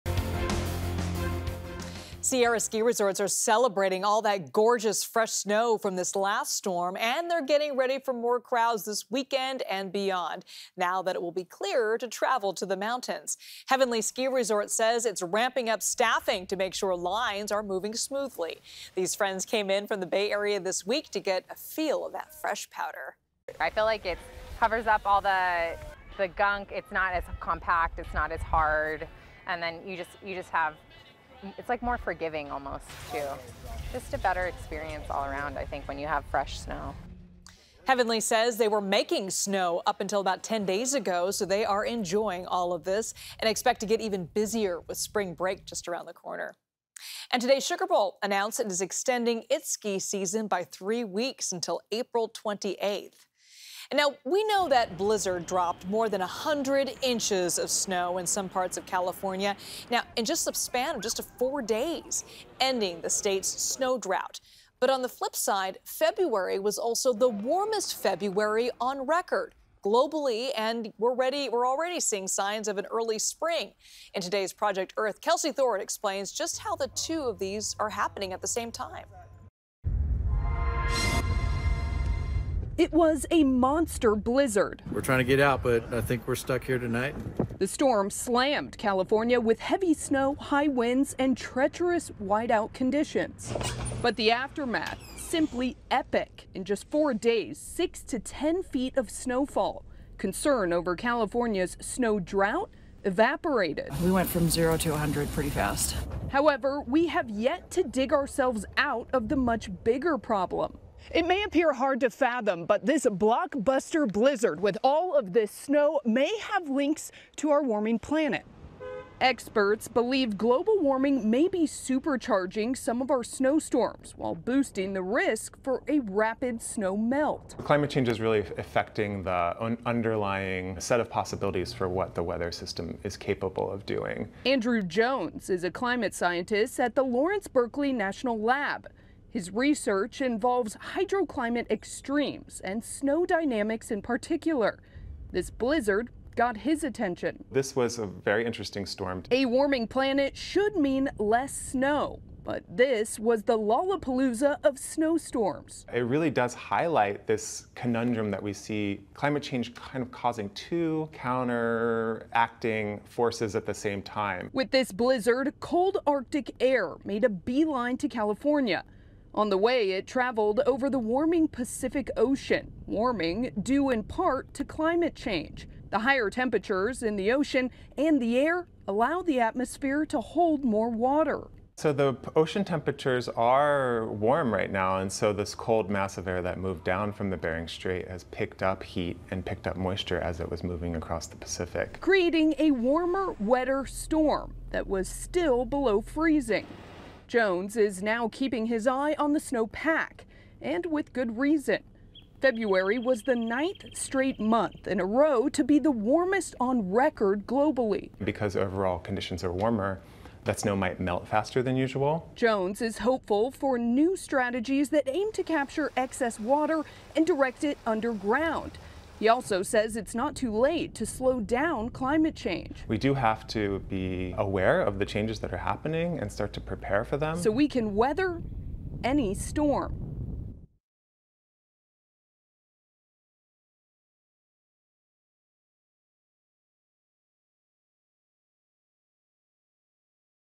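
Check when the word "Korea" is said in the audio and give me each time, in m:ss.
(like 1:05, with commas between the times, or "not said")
not said.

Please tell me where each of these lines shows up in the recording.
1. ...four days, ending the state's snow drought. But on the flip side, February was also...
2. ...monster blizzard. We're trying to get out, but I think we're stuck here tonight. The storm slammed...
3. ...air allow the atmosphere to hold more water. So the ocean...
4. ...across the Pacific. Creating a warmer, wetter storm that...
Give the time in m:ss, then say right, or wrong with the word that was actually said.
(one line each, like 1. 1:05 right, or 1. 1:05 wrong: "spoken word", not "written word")
1. 1:01 right
2. 1:23 right
3. 2:58 right
4. 3:10 right.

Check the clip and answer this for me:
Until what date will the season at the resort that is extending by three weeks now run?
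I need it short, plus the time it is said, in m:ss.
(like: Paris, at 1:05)
April 28th, at 0:51.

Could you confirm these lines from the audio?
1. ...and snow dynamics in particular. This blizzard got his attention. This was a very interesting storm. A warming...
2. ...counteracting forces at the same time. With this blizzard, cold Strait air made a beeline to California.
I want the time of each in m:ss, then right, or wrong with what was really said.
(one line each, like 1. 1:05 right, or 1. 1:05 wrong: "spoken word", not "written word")
1. 2:22 right
2. 2:41 wrong: "Arctic", not "Strait".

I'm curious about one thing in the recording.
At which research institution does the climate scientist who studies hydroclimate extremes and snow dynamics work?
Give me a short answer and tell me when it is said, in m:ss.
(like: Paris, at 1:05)
Lawrence Berkeley National Lab, at 2:17.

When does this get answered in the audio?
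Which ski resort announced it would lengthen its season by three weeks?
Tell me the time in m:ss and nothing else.
0:47.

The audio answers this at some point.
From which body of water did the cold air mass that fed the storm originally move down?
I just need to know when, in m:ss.
3:07.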